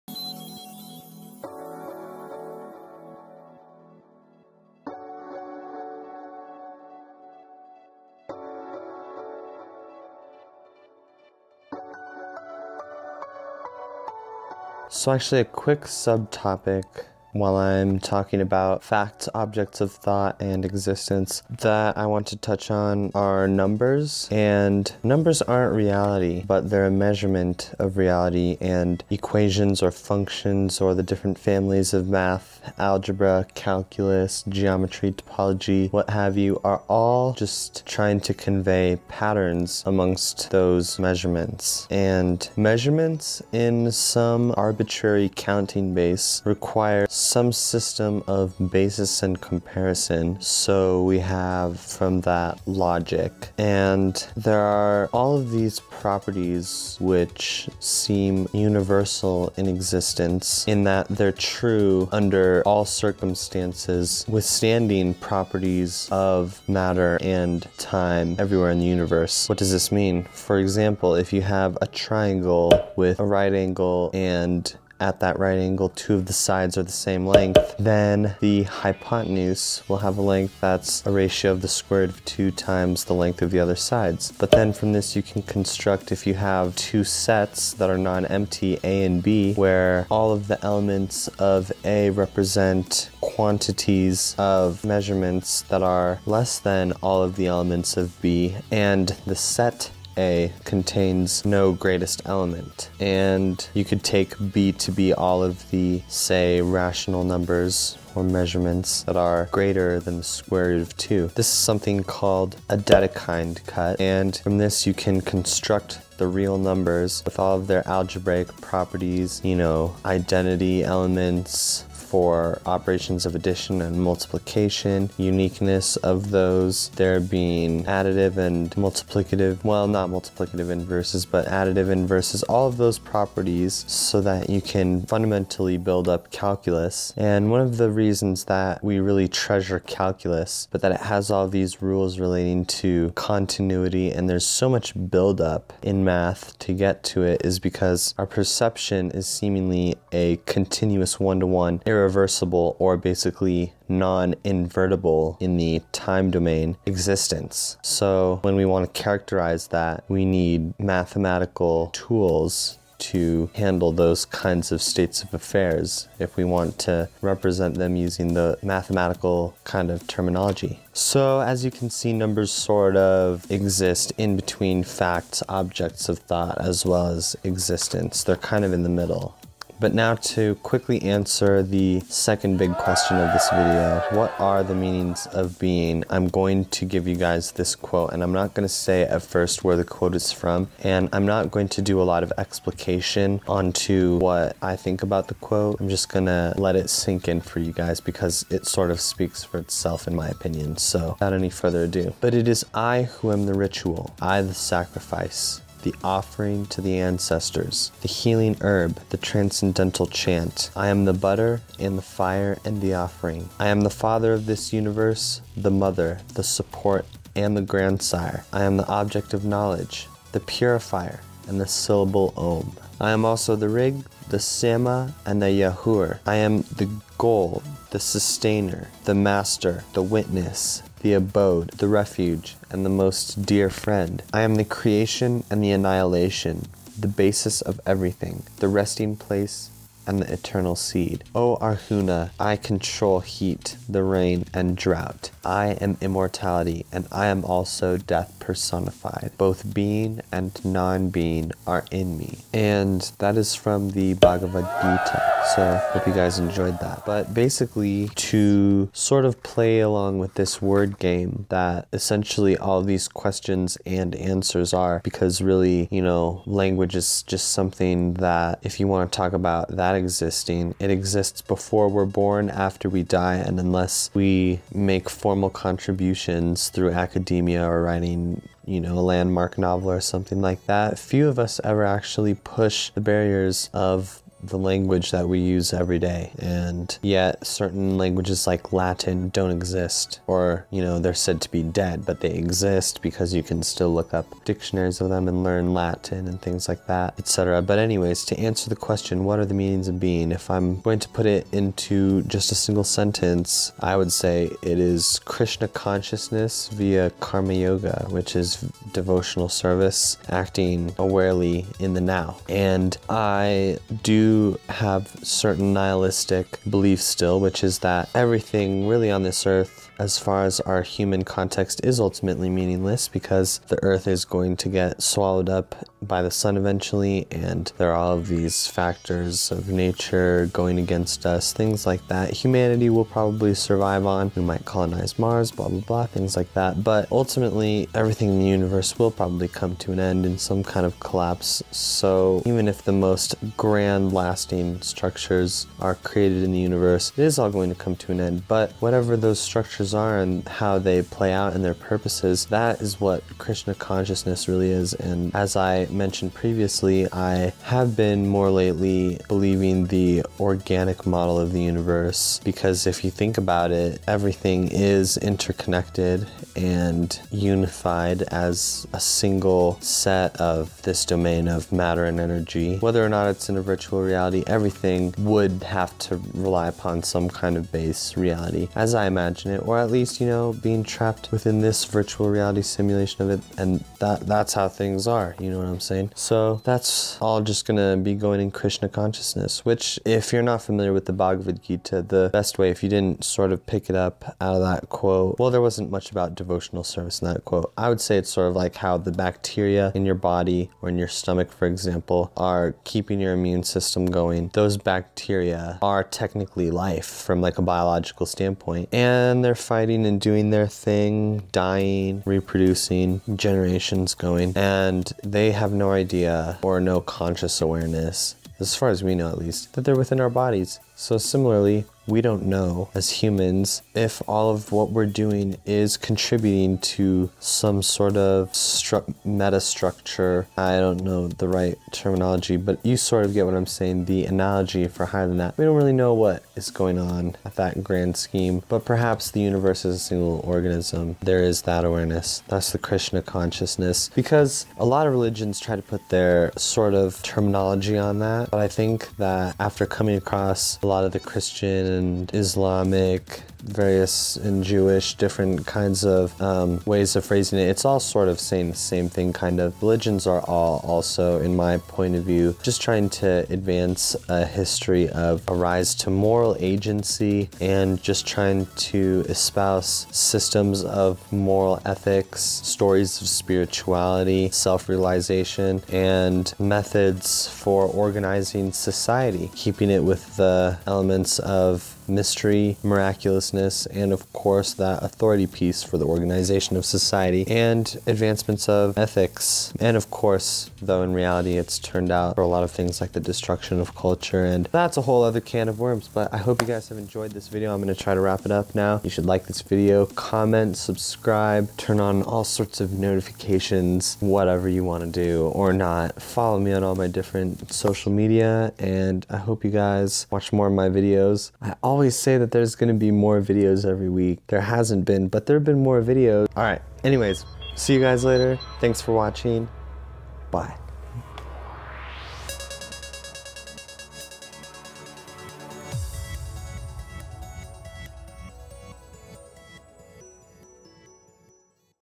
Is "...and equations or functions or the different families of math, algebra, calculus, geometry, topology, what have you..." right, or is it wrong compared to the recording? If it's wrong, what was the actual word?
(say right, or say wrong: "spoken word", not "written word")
right.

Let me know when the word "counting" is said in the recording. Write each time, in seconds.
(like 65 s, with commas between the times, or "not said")
45 s.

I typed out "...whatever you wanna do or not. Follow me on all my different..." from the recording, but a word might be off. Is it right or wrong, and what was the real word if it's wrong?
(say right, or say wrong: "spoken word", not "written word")
right.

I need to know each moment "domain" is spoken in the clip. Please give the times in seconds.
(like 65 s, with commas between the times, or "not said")
156 s, 371 s.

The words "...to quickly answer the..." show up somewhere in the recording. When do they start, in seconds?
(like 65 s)
180 s.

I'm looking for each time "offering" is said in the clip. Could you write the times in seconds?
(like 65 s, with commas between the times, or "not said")
206 s, 212 s.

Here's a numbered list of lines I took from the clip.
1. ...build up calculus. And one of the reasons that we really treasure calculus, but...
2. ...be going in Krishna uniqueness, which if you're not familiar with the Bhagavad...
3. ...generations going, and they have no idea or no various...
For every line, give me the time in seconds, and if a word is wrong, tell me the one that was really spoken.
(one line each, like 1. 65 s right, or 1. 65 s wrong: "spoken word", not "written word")
1. 135 s right
2. 387 s wrong: "consciousness", not "uniqueness"
3. 413 s wrong: "conscious", not "various".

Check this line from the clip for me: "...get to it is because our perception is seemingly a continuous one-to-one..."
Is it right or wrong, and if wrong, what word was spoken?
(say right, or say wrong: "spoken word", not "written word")
right.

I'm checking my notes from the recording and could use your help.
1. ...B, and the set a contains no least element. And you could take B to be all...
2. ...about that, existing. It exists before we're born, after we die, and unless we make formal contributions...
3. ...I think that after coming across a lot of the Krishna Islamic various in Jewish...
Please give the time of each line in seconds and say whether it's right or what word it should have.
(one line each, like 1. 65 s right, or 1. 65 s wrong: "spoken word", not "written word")
1. 98 s wrong: "greatest", not "least"
2. 269 s right
3. 448 s wrong: "Christian", not "Krishna".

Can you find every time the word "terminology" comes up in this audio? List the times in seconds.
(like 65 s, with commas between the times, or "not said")
170 s, 431 s, 447 s.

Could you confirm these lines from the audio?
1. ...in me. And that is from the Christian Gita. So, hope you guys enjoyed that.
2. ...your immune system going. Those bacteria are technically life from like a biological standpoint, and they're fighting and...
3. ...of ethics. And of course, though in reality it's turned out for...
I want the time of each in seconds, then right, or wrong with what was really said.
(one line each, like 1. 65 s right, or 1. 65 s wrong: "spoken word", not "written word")
1. 251 s wrong: "Bhagavad", not "Christian"
2. 403 s right
3. 488 s right.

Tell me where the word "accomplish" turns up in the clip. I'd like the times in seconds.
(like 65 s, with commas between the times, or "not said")
not said.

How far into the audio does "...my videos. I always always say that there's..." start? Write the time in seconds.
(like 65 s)
510 s.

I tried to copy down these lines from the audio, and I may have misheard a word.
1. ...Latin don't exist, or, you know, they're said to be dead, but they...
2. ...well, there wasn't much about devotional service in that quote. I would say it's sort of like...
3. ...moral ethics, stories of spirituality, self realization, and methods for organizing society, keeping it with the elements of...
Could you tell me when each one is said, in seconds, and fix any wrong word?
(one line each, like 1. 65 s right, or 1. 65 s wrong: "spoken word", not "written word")
1. 288 s right
2. 395 s right
3. 471 s right.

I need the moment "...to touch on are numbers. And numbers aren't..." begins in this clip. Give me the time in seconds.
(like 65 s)
22 s.